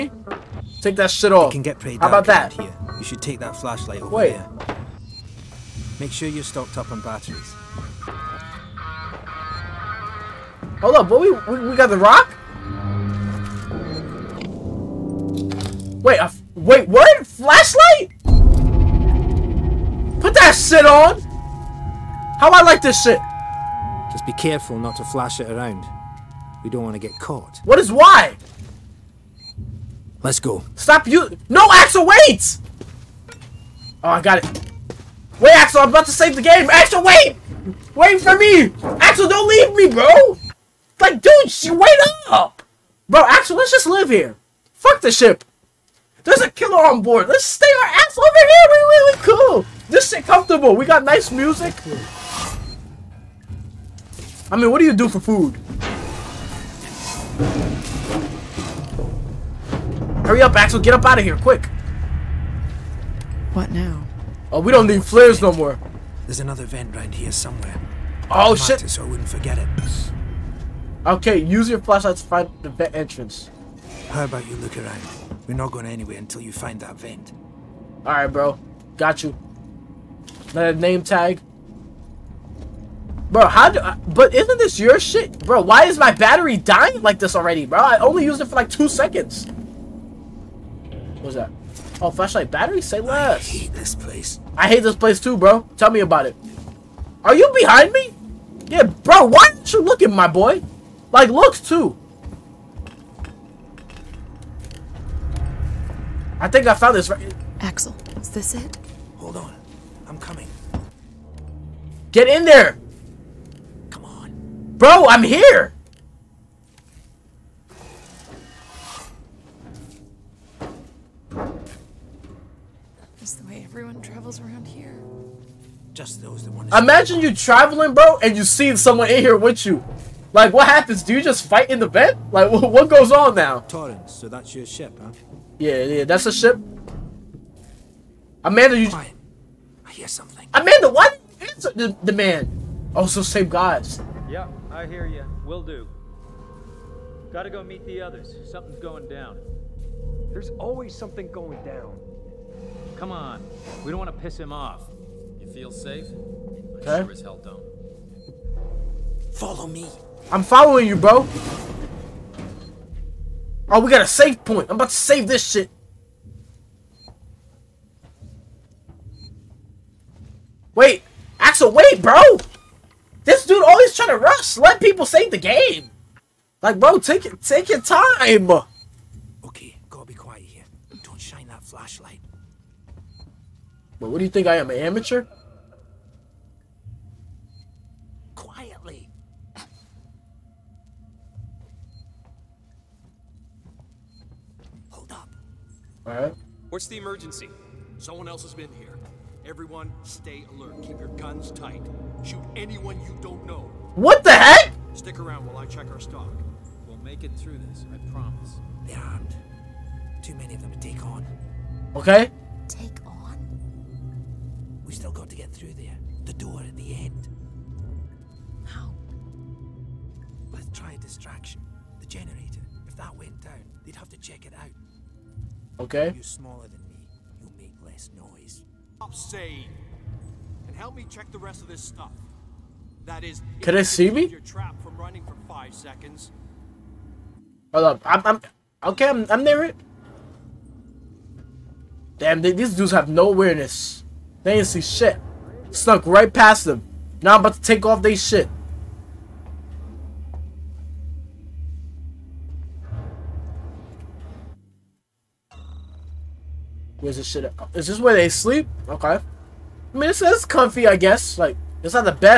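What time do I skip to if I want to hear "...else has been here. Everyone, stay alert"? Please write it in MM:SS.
03:18.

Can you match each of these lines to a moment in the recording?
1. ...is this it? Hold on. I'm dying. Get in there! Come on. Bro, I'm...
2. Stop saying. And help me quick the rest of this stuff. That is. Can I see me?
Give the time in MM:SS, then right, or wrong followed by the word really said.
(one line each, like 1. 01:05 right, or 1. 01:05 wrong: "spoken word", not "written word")
1. 01:48 wrong: "coming", not "dying"
2. 03:48 wrong: "check", not "quick".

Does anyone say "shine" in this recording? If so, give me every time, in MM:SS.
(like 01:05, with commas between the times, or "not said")
03:01.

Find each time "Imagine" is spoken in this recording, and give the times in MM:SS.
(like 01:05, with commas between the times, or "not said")
02:06.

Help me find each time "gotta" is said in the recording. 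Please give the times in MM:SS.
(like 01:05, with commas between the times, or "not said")
02:27, 02:59.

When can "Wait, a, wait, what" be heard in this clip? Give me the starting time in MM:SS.
00:16.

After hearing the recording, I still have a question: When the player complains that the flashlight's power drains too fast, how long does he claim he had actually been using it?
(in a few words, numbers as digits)
two seconds.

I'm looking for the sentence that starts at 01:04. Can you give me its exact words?
Oh, we don't need flares no more.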